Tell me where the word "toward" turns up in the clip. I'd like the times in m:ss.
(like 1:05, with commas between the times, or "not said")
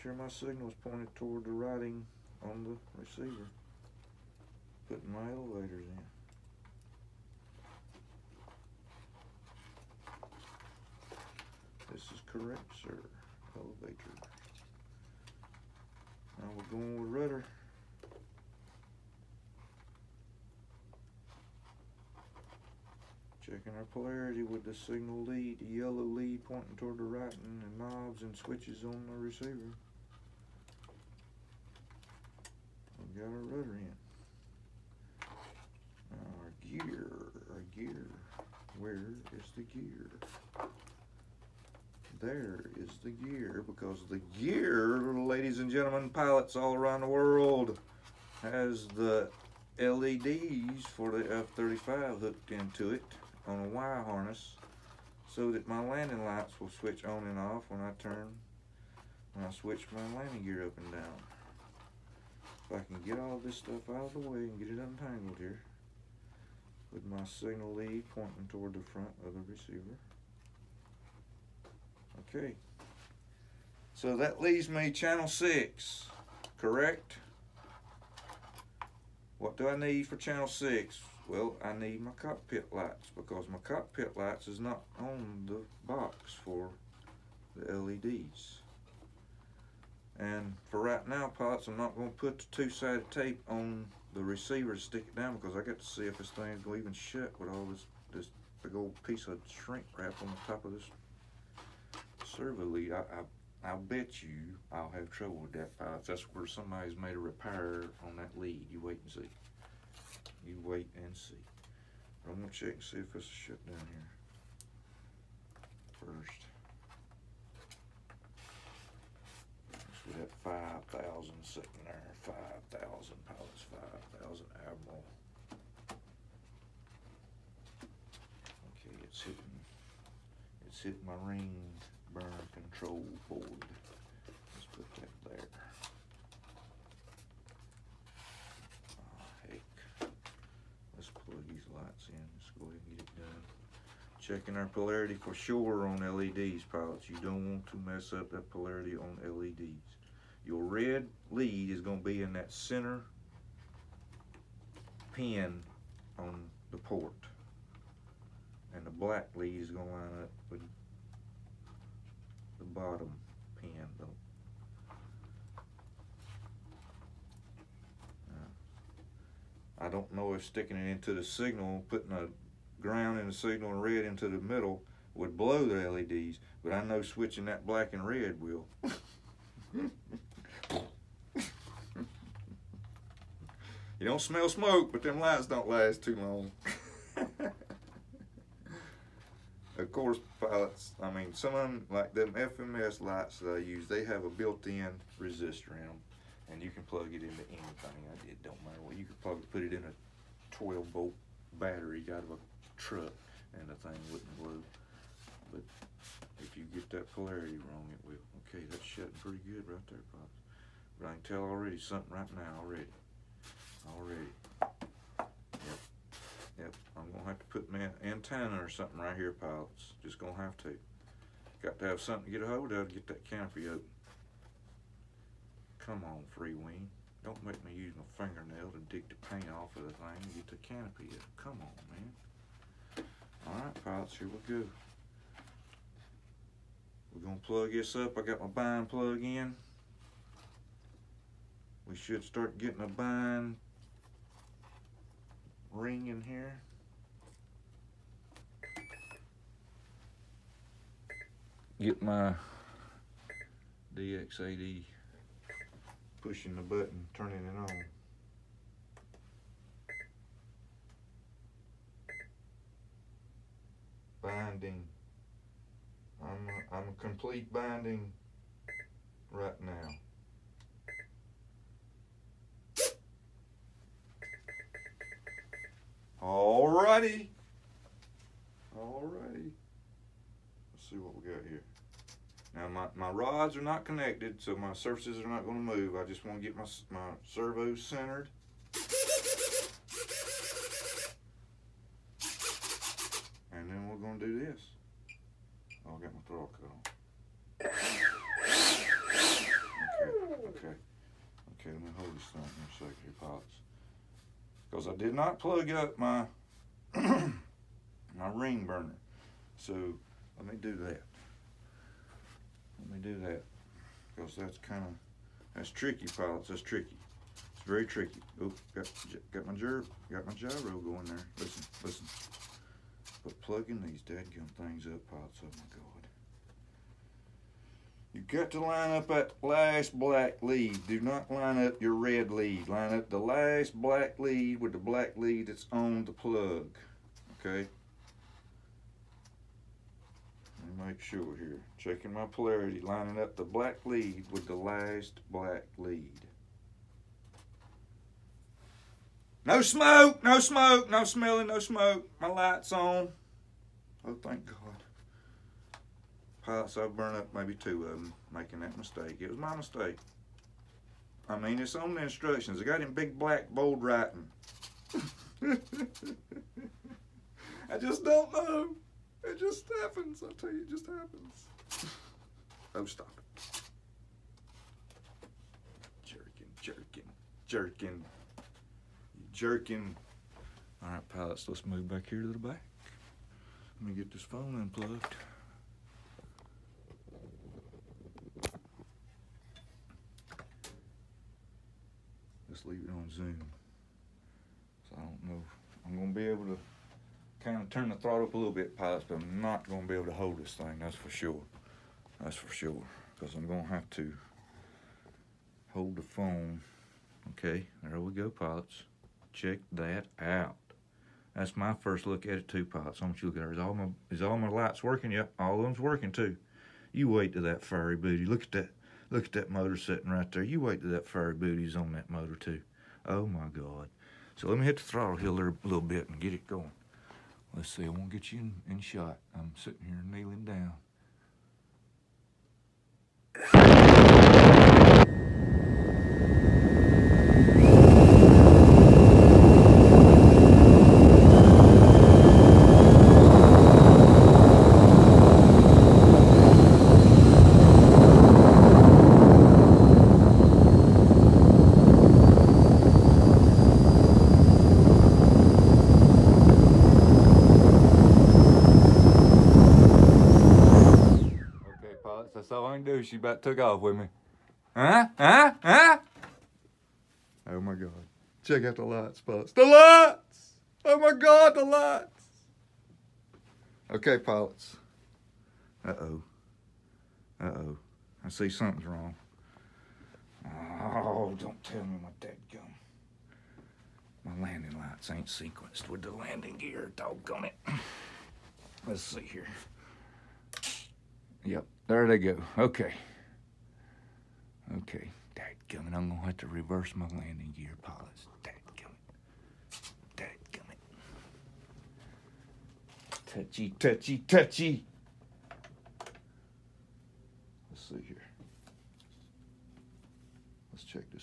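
0:01, 0:26, 1:08.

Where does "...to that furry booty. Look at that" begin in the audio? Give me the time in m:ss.
6:57.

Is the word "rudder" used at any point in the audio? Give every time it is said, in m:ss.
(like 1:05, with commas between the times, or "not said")
0:17, 0:33.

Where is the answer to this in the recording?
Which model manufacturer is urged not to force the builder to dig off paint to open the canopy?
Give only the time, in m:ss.
3:46.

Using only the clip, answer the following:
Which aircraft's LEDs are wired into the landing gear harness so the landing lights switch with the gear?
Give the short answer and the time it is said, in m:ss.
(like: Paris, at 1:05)
F-35, at 0:51.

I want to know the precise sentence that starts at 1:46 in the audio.
That's where somebody's made a repair on that lead.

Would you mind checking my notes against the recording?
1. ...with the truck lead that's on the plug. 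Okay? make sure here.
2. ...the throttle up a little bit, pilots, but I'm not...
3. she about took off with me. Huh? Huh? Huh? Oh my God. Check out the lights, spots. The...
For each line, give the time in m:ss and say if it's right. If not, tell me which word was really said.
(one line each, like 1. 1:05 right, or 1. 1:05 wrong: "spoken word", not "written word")
1. 5:34 wrong: "black", not "truck"
2. 6:37 right
3. 7:43 right.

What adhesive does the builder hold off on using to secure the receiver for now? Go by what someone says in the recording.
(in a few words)
two-sided tape.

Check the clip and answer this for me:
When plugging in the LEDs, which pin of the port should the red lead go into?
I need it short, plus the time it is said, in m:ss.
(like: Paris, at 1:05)
center pin, at 2:32.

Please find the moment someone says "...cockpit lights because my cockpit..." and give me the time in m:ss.
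1:22.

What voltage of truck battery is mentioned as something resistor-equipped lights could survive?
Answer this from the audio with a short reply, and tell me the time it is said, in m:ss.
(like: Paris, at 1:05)
12-volt, at 3:20.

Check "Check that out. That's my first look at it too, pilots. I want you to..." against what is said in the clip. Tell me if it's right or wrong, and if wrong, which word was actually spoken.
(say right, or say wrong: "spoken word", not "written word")
right.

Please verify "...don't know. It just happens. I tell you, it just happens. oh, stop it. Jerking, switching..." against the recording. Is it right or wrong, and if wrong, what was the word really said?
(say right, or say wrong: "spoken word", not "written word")
wrong: "jerking", not "switching".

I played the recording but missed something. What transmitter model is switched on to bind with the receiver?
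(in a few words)
DX8E.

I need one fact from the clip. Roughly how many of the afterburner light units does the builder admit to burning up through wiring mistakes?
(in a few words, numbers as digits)
2.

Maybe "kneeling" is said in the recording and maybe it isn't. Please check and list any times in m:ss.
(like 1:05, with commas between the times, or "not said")
7:10.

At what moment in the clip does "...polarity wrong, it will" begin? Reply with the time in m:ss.
3:27.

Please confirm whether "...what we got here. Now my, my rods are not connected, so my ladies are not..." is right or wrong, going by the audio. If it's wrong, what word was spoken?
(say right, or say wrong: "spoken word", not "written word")
wrong: "surfaces", not "ladies".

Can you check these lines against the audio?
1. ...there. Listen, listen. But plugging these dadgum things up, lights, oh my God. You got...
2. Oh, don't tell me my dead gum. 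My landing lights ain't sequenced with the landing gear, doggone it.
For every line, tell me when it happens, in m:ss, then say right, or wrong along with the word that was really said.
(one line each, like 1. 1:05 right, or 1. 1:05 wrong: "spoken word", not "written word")
1. 5:21 wrong: "pilots", not "lights"
2. 8:00 right.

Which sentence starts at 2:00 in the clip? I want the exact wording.
we have 5,000 sitting there, 5,000 pilots, 5,000 admiral.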